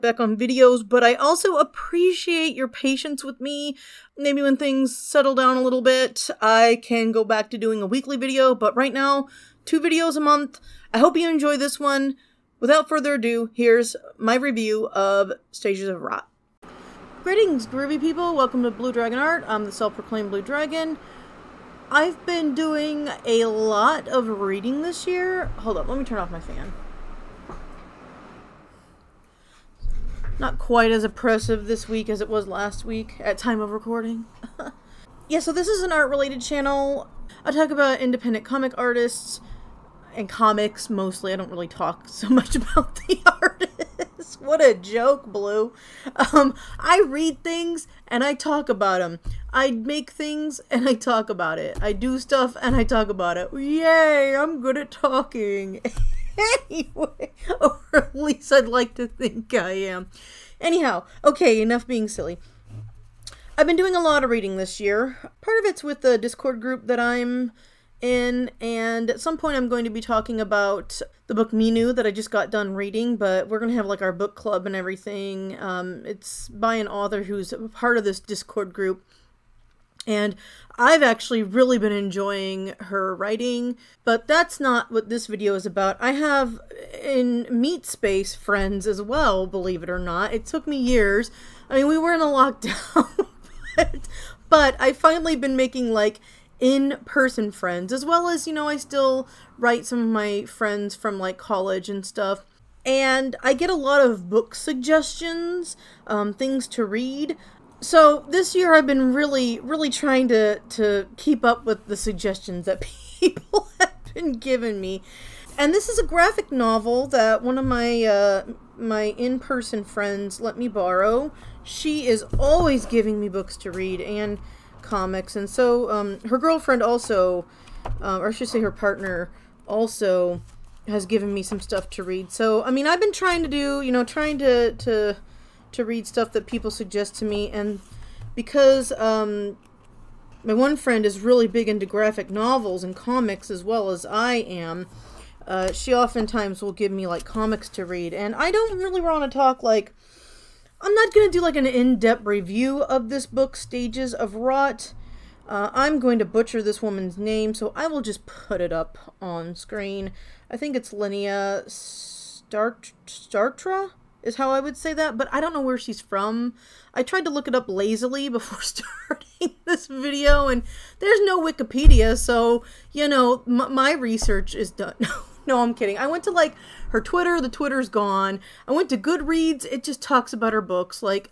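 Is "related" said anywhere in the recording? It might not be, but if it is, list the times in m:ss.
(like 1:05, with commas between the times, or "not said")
0:35.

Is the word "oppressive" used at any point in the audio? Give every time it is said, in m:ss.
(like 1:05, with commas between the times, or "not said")
0:31.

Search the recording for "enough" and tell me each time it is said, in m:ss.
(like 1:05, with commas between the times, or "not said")
1:01.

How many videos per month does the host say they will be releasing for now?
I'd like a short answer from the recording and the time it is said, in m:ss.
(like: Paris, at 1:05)
2, at 0:09.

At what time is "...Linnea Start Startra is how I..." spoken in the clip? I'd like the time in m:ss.
2:40.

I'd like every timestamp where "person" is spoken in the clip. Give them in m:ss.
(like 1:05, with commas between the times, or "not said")
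1:37, 1:59.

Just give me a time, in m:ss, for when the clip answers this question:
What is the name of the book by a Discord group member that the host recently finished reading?
1:11.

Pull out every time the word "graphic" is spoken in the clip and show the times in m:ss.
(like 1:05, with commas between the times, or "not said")
1:56, 2:21.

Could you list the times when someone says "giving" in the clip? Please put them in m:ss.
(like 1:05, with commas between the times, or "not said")
1:54, 2:02.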